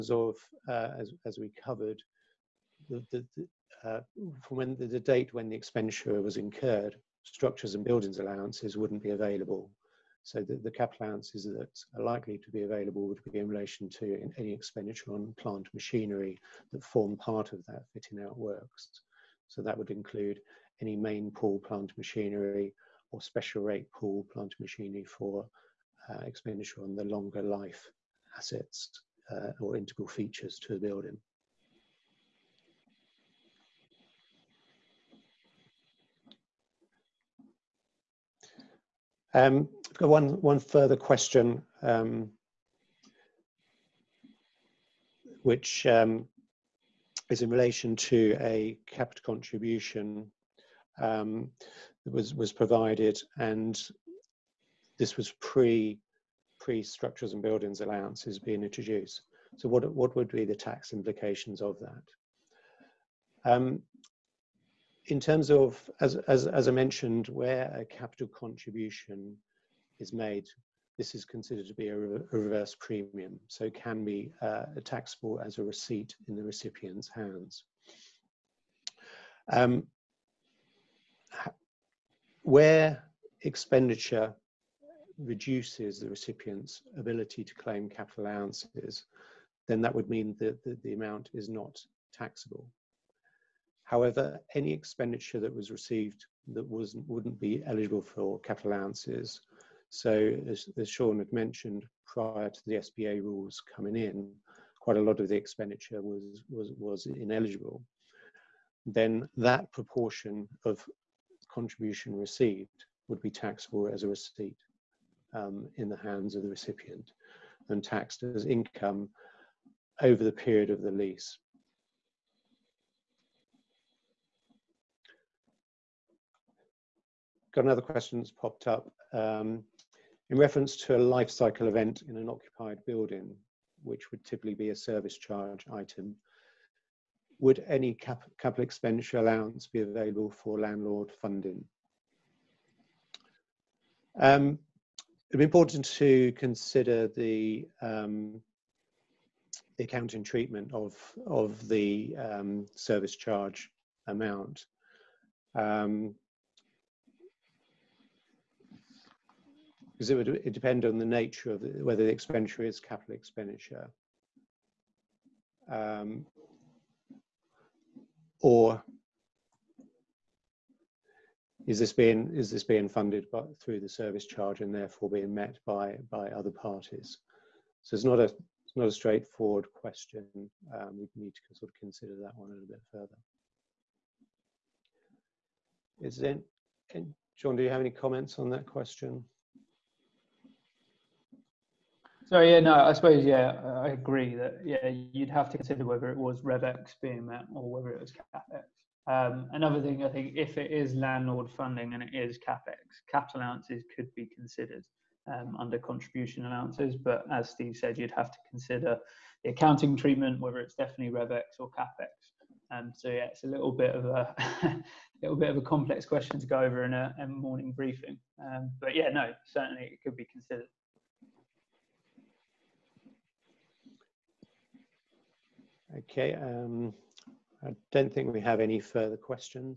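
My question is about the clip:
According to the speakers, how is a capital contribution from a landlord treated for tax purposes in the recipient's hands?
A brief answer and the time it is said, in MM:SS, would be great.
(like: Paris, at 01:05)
A reverse premium, at 01:12.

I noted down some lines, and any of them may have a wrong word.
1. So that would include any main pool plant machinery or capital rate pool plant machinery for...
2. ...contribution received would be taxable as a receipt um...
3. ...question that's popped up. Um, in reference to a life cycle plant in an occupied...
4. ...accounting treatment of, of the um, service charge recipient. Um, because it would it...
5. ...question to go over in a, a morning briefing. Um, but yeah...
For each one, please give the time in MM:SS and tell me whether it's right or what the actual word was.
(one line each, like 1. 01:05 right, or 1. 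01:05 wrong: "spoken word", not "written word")
1. 00:19 wrong: "special", not "capital"
2. 01:51 right
3. 02:07 wrong: "event", not "plant"
4. 02:29 wrong: "amount", not "recipient"
5. 03:36 right.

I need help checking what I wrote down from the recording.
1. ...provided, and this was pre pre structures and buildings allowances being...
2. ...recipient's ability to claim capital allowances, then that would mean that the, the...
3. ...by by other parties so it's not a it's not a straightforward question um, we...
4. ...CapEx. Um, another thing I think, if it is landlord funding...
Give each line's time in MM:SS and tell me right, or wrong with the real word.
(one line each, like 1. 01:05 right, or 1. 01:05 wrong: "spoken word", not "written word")
1. 00:52 right
2. 01:26 right
3. 02:55 right
4. 03:18 right.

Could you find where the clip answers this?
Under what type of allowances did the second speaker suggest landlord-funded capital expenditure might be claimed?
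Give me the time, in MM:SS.
03:25.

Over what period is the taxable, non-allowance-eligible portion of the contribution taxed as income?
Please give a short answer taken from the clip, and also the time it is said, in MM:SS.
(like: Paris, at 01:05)
The period of the lease, at 02:00.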